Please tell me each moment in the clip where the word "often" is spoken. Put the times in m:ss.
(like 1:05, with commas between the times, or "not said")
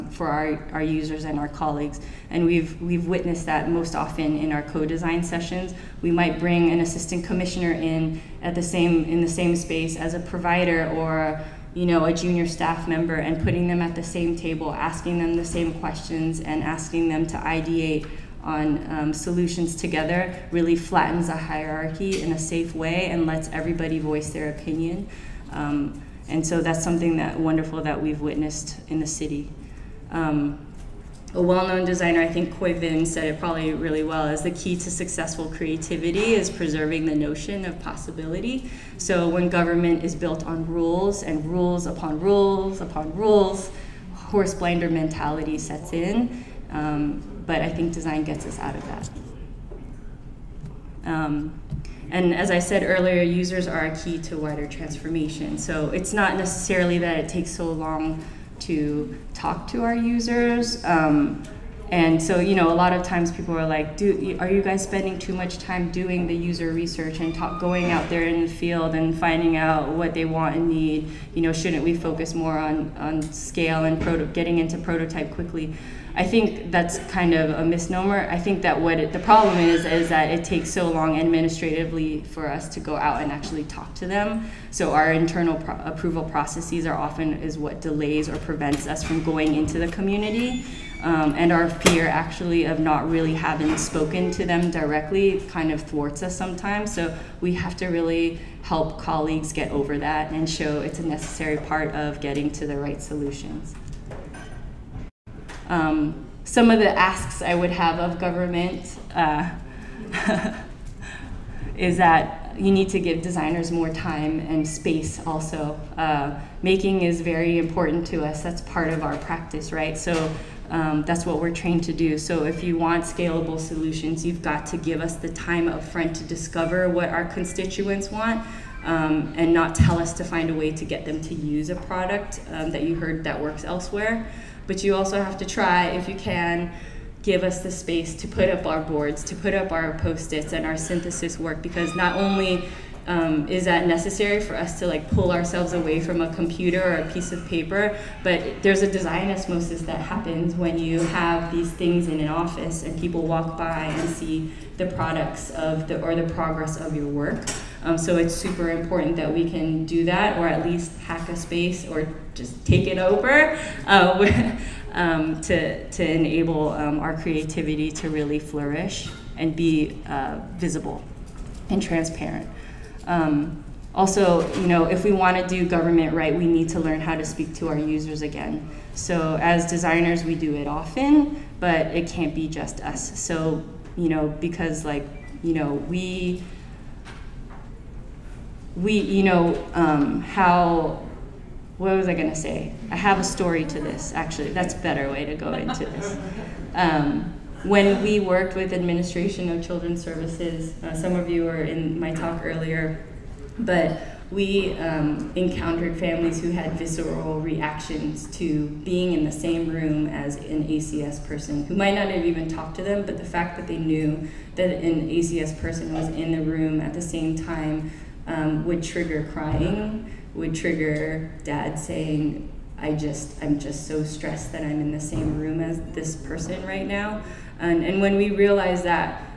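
0:03, 1:26, 3:00.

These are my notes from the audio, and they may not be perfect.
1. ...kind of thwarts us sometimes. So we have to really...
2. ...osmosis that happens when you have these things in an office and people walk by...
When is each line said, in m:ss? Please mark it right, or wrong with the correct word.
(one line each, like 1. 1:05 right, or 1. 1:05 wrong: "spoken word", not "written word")
1. 1:35 right
2. 2:29 right.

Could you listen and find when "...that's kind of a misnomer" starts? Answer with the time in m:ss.
1:16.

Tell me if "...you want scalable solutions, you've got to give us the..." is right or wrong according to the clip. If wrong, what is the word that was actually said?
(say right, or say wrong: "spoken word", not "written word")
right.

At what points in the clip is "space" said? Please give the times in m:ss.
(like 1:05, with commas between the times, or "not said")
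0:09, 1:54, 2:17, 2:41.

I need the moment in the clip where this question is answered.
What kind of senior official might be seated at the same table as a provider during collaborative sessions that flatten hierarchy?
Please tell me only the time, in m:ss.
0:06.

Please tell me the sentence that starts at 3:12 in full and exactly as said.
I have a story to this, actually.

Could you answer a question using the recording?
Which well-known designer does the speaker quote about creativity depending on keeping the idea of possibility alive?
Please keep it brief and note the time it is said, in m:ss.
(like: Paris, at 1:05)
Khoi Vinh, at 0:32.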